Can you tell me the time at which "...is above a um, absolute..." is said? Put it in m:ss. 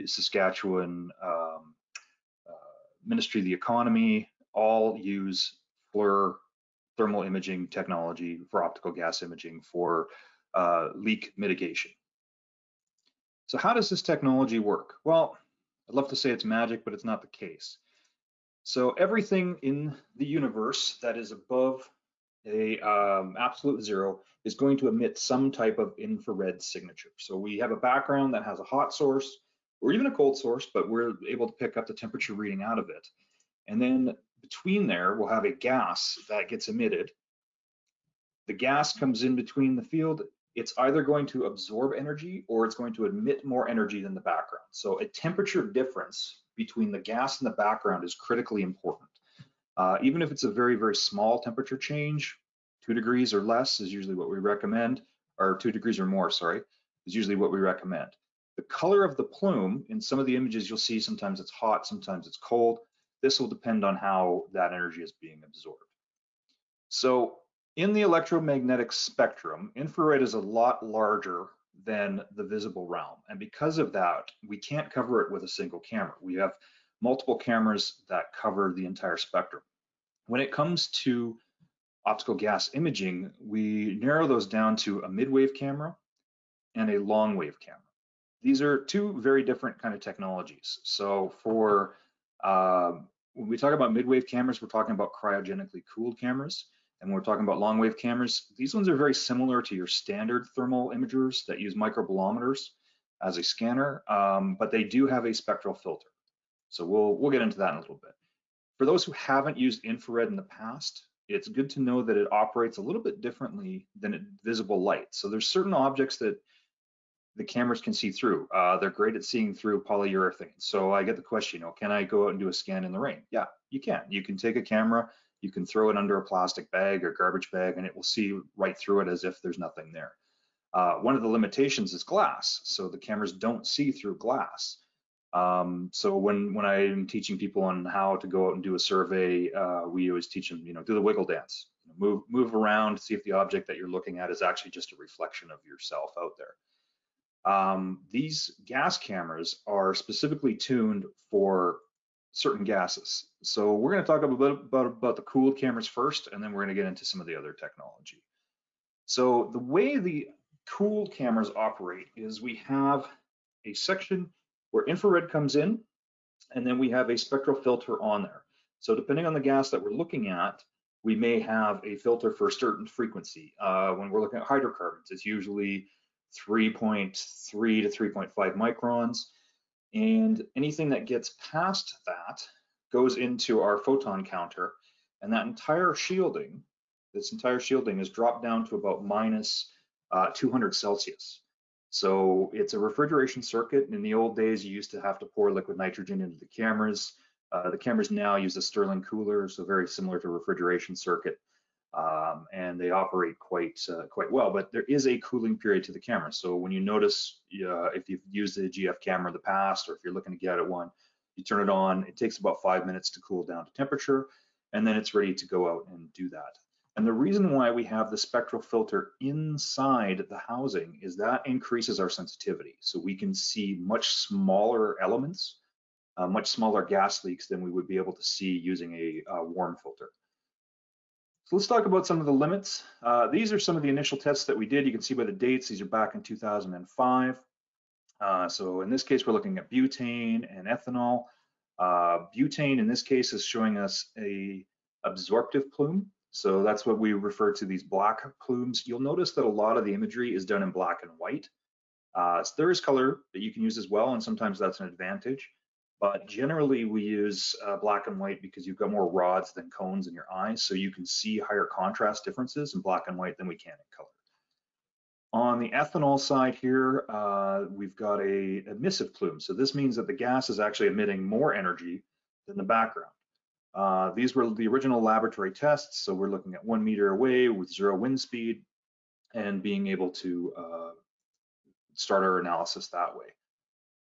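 0:21.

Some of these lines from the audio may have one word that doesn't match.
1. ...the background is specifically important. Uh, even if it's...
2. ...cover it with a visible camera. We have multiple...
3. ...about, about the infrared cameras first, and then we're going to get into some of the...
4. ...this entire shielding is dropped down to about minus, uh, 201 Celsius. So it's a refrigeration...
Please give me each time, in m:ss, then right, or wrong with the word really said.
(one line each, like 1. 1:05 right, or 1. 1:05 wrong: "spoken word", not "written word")
1. 0:47 wrong: "critically", not "specifically"
2. 1:14 wrong: "single", not "visible"
3. 2:34 wrong: "cooled", not "infrared"
4. 3:07 wrong: "200", not "201".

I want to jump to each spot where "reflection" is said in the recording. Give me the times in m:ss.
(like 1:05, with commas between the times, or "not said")
2:24.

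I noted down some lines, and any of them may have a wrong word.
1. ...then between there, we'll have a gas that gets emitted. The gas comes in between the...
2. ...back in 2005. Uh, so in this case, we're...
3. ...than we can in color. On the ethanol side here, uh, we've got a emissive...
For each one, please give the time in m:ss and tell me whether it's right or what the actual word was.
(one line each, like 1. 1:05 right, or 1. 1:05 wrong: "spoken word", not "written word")
1. 0:33 right
2. 3:55 right
3. 4:23 right.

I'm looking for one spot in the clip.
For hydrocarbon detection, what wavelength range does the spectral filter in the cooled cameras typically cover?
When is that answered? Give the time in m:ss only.
2:56.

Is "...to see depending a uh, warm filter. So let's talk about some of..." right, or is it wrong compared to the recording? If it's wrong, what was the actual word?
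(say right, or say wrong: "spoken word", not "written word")
wrong: "using", not "depending".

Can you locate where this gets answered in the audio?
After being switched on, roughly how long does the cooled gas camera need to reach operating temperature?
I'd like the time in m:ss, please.
3:32.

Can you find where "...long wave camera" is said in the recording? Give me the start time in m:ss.
1:26.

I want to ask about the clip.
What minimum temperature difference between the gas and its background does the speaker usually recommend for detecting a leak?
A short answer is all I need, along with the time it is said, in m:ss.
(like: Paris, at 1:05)
2 degrees or more, at 0:55.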